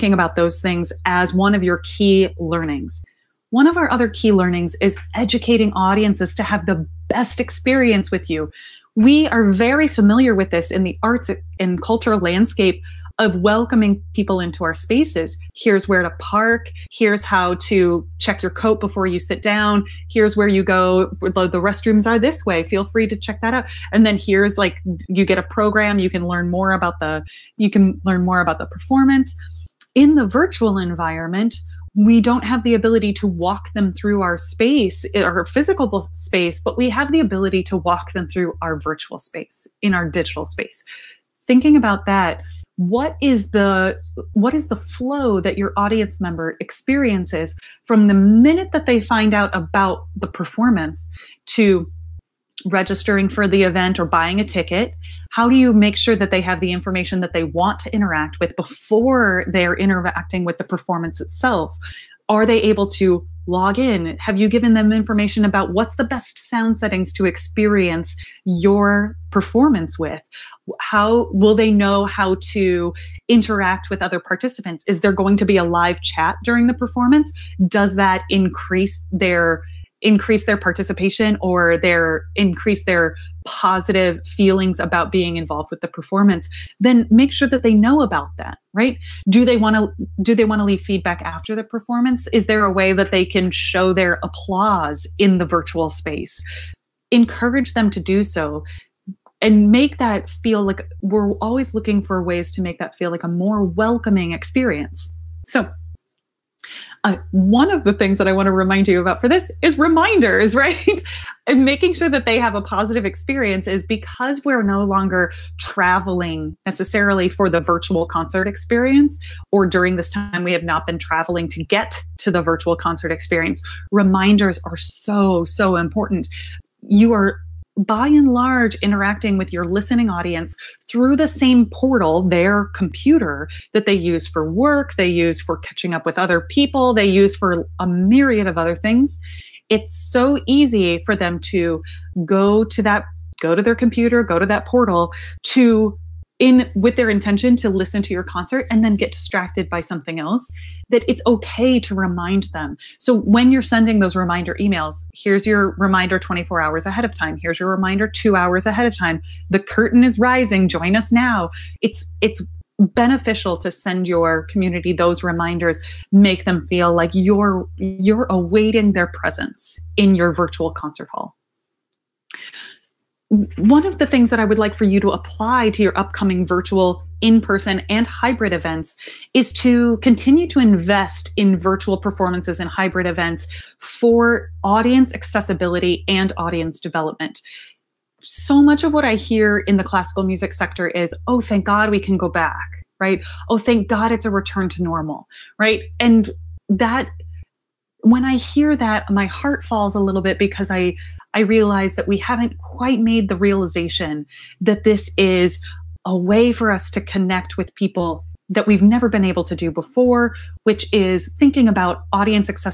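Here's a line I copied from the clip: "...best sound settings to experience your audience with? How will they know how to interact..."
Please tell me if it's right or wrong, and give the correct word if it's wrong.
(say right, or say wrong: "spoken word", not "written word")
wrong: "performance", not "audience".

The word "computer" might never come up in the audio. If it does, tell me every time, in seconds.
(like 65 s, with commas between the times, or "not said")
132 s, 143 s.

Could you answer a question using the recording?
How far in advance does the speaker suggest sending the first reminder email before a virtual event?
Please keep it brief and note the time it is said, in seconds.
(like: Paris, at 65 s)
24 hours, at 156 s.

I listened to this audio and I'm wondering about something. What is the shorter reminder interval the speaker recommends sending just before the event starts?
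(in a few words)
2 hours.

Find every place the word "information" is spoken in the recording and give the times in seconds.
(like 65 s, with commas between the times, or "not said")
56 s, 64 s.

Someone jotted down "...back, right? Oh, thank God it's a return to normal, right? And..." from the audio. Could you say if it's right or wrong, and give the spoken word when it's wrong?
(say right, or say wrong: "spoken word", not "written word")
right.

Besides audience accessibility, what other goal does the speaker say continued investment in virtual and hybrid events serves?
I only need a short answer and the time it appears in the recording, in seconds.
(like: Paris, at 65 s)
audience development, at 186 s.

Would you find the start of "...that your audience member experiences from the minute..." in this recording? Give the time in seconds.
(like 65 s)
45 s.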